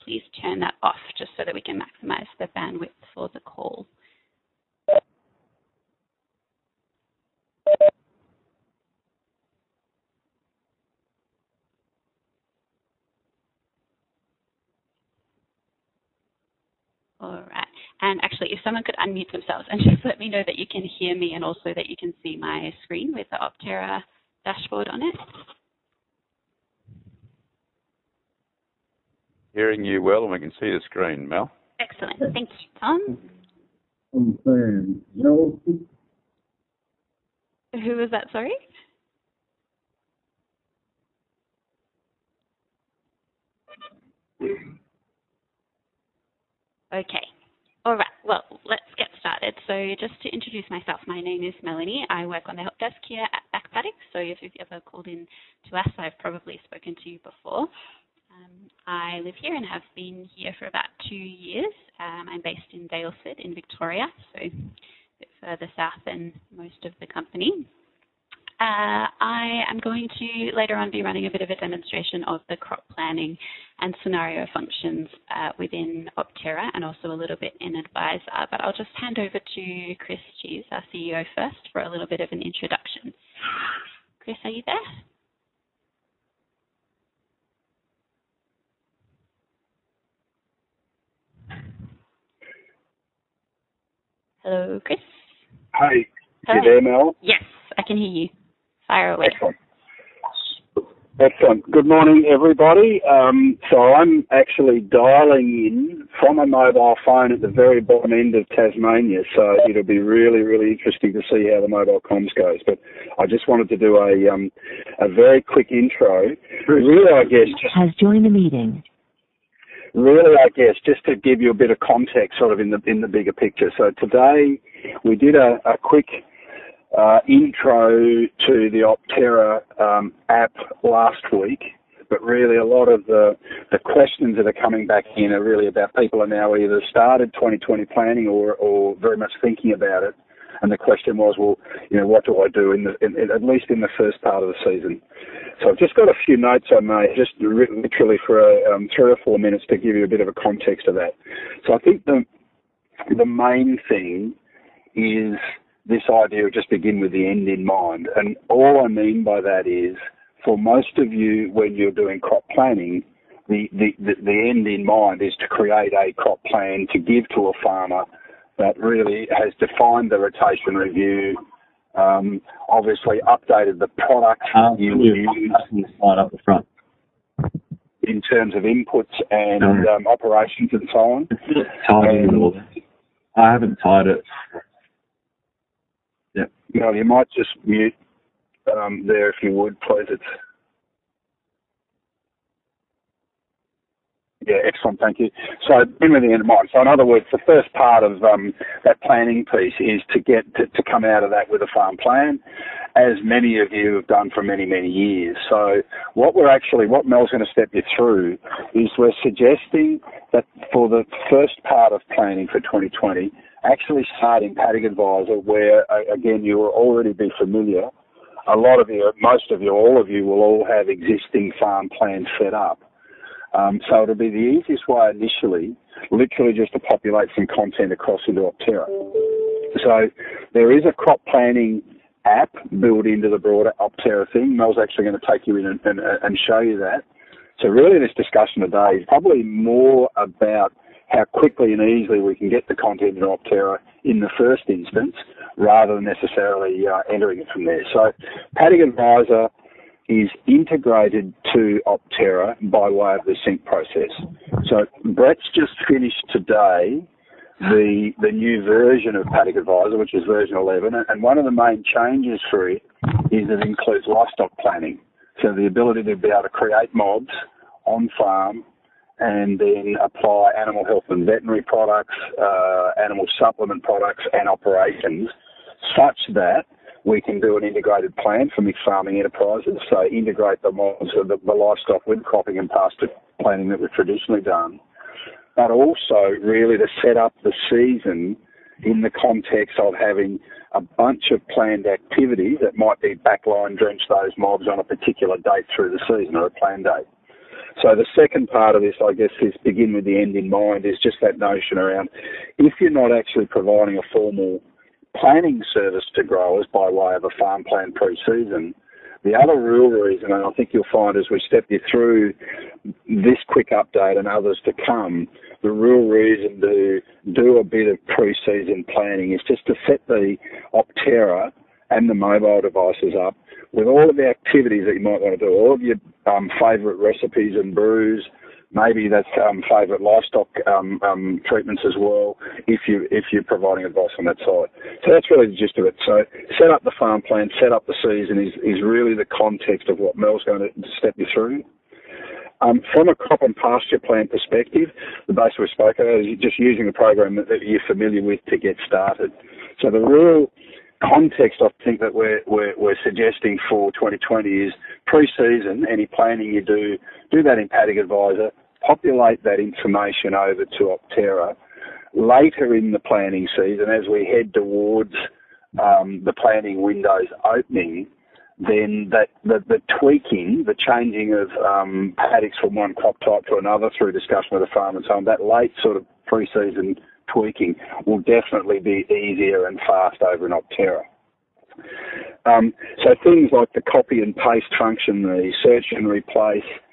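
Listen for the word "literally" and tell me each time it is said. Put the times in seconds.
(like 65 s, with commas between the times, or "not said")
147 s, 226 s.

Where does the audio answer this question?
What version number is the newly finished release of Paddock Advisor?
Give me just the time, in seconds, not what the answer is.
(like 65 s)
260 s.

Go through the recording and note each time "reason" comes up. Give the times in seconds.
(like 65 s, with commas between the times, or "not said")
309 s, 316 s.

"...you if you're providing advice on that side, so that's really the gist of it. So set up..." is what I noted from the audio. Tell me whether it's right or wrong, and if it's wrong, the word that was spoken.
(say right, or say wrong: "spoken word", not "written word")
right.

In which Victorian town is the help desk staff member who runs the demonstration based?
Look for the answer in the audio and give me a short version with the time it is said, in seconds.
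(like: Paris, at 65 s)
Daylesford, at 62 s.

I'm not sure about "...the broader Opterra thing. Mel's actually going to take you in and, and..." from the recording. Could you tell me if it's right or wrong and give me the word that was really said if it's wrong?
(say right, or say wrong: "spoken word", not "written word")
right.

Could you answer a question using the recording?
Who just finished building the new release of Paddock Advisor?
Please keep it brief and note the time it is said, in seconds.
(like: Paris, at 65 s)
Brett, at 255 s.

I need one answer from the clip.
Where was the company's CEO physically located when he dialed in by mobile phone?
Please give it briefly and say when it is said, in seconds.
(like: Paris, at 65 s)
Tasmania, at 108 s.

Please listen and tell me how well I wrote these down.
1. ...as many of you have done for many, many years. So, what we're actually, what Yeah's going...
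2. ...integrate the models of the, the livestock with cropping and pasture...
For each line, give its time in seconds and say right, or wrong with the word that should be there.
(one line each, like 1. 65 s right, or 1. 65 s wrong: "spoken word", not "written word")
1. 202 s wrong: "Mel", not "Yeah"
2. 280 s right.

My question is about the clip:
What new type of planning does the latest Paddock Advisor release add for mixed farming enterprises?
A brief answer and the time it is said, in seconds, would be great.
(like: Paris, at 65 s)
livestock planning, at 264 s.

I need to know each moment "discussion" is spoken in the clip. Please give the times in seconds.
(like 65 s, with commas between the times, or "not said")
238 s, 374 s.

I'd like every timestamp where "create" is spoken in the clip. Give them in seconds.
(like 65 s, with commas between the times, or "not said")
165 s, 266 s.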